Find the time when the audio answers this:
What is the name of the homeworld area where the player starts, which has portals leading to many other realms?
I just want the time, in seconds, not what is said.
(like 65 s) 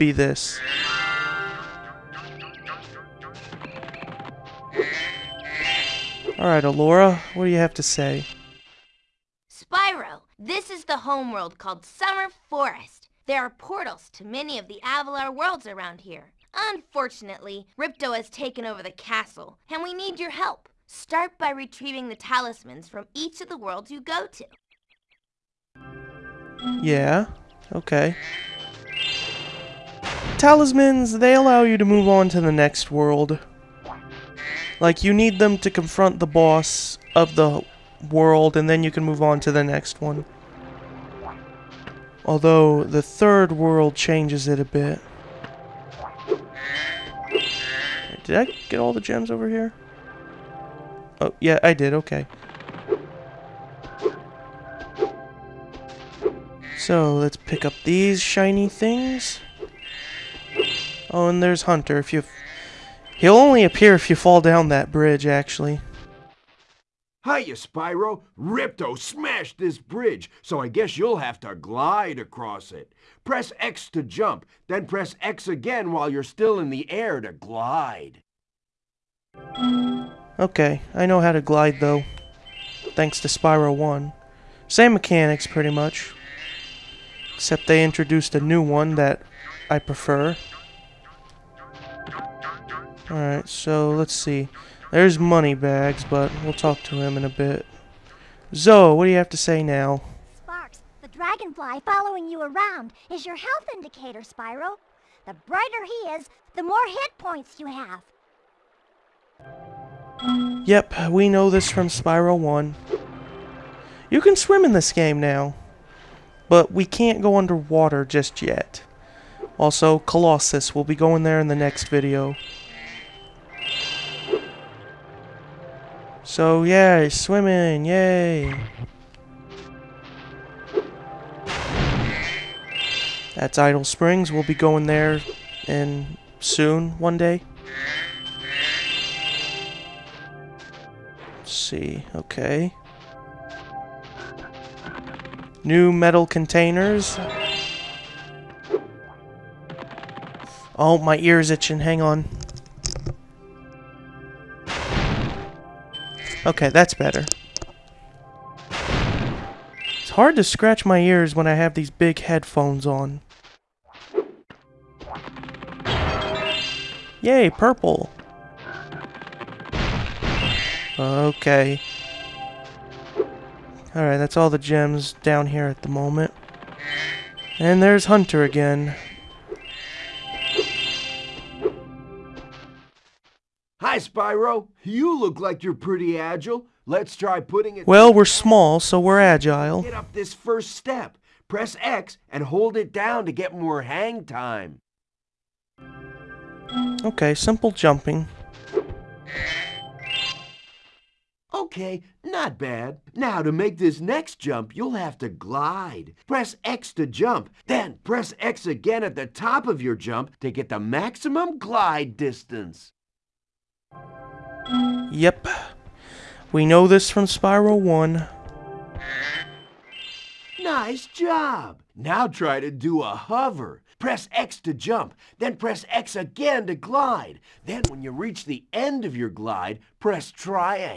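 11 s.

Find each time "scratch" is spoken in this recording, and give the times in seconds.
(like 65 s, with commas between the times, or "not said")
160 s.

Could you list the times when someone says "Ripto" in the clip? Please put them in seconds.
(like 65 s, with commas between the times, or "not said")
17 s, 68 s.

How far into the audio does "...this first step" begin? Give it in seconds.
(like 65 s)
190 s.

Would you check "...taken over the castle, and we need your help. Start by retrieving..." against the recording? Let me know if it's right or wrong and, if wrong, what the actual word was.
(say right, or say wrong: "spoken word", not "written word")
right.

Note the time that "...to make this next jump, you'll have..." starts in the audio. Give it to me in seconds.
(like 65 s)
203 s.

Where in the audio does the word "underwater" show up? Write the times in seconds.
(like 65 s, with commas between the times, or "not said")
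117 s.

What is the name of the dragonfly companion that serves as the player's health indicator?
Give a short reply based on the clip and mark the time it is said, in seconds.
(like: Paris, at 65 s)
Sparks, at 100 s.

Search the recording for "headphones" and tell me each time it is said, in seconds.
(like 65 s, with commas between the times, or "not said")
162 s.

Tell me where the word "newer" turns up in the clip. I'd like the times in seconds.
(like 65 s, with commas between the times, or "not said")
not said.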